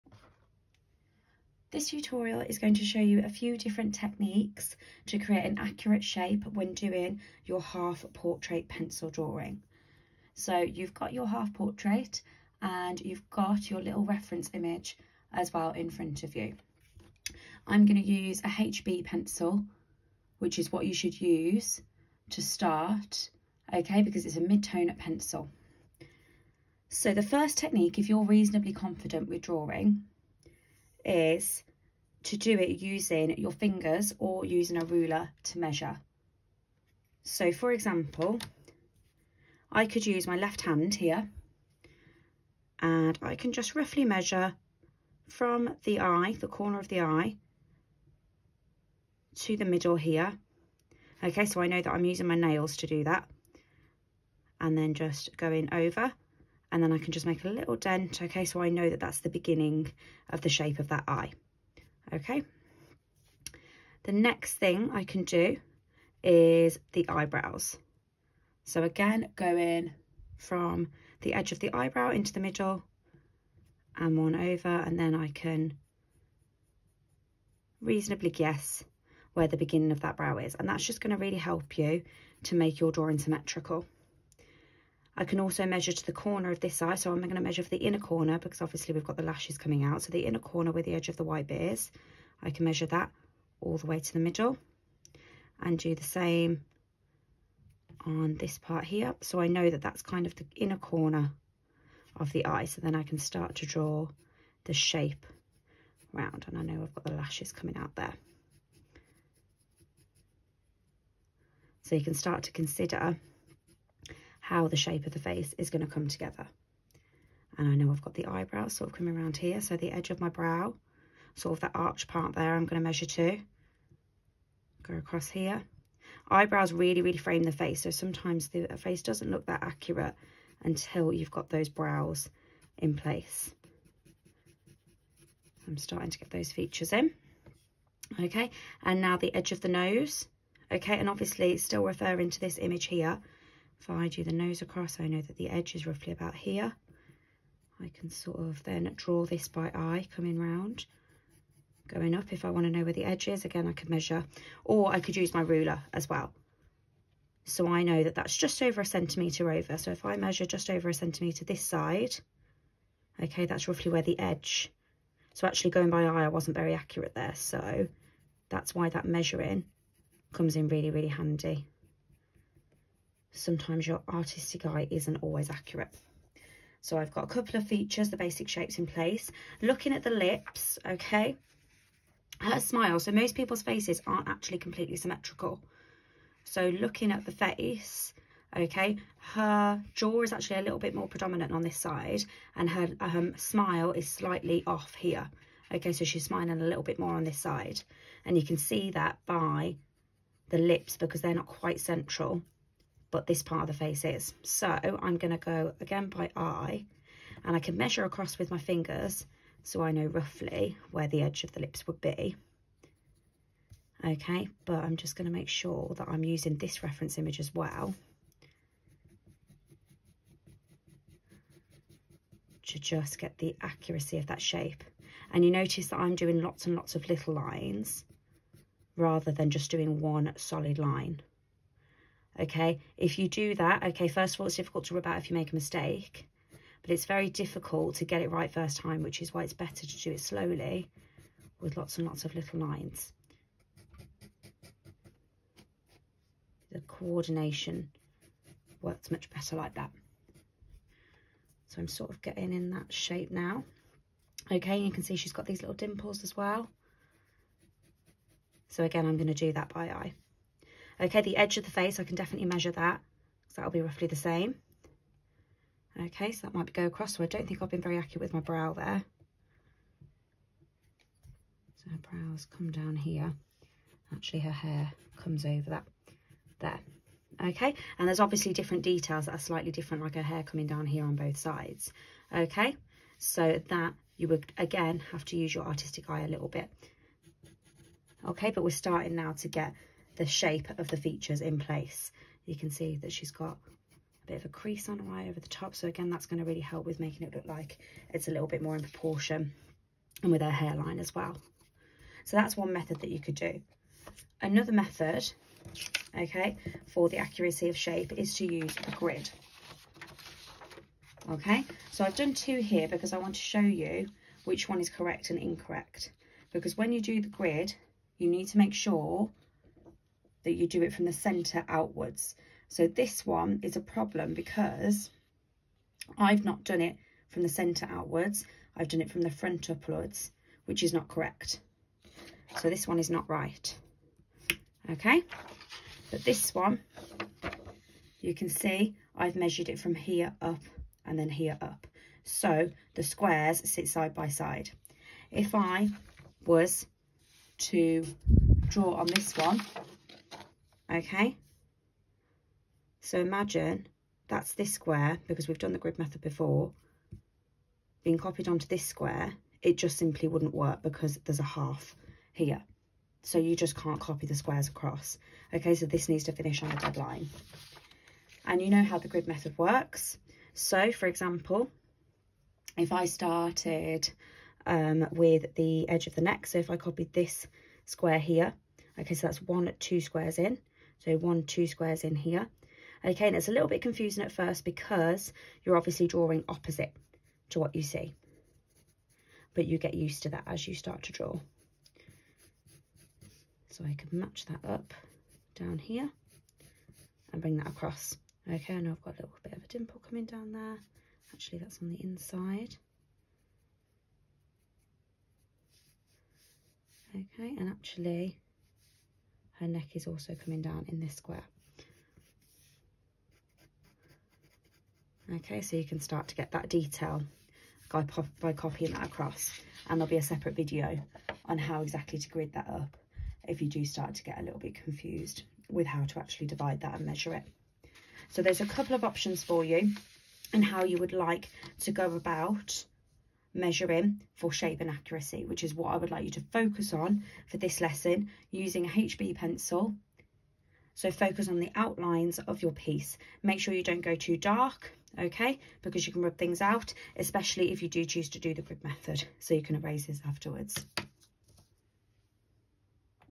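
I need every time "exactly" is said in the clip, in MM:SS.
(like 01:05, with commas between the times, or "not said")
07:01.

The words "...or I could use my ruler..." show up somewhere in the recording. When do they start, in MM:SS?
02:34.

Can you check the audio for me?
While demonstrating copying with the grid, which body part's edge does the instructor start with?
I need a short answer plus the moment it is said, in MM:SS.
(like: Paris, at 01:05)
The neck, at 06:16.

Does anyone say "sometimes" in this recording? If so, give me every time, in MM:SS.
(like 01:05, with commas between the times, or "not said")
02:07, 02:53.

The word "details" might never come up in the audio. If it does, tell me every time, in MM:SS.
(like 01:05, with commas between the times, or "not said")
04:38, 06:56.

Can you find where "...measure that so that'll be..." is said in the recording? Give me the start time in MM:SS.
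04:22.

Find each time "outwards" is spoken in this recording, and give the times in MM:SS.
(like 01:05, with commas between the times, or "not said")
05:21, 05:27.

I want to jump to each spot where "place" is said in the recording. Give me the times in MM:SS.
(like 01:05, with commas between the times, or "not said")
02:12, 02:58, 04:51.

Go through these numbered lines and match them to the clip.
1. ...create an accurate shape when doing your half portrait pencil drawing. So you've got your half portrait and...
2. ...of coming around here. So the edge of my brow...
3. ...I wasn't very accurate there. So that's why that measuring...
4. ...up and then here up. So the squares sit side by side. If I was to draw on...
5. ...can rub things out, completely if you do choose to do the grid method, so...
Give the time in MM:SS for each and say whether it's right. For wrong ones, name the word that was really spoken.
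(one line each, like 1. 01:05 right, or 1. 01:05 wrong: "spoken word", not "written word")
1. 00:05 right
2. 01:58 right
3. 02:46 right
4. 05:40 right
5. 07:26 wrong: "especially", not "completely".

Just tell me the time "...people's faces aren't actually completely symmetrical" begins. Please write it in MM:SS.
03:03.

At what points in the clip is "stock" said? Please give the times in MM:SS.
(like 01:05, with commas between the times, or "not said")
not said.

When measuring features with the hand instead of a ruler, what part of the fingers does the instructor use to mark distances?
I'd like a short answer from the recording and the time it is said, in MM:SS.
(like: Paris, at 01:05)
Nails, at 00:52.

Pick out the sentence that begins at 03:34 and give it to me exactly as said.
Okay, but I'm just going to make sure that I'm using this reference image as well.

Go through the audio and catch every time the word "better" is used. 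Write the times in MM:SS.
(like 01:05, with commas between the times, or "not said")
03:59, 04:09.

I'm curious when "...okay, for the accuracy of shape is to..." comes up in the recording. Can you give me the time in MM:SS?
05:06.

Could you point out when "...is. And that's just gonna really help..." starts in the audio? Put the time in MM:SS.
01:20.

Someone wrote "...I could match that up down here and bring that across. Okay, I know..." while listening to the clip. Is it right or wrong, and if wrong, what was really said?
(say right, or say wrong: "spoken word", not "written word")
right.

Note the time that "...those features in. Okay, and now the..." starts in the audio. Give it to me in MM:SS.
02:16.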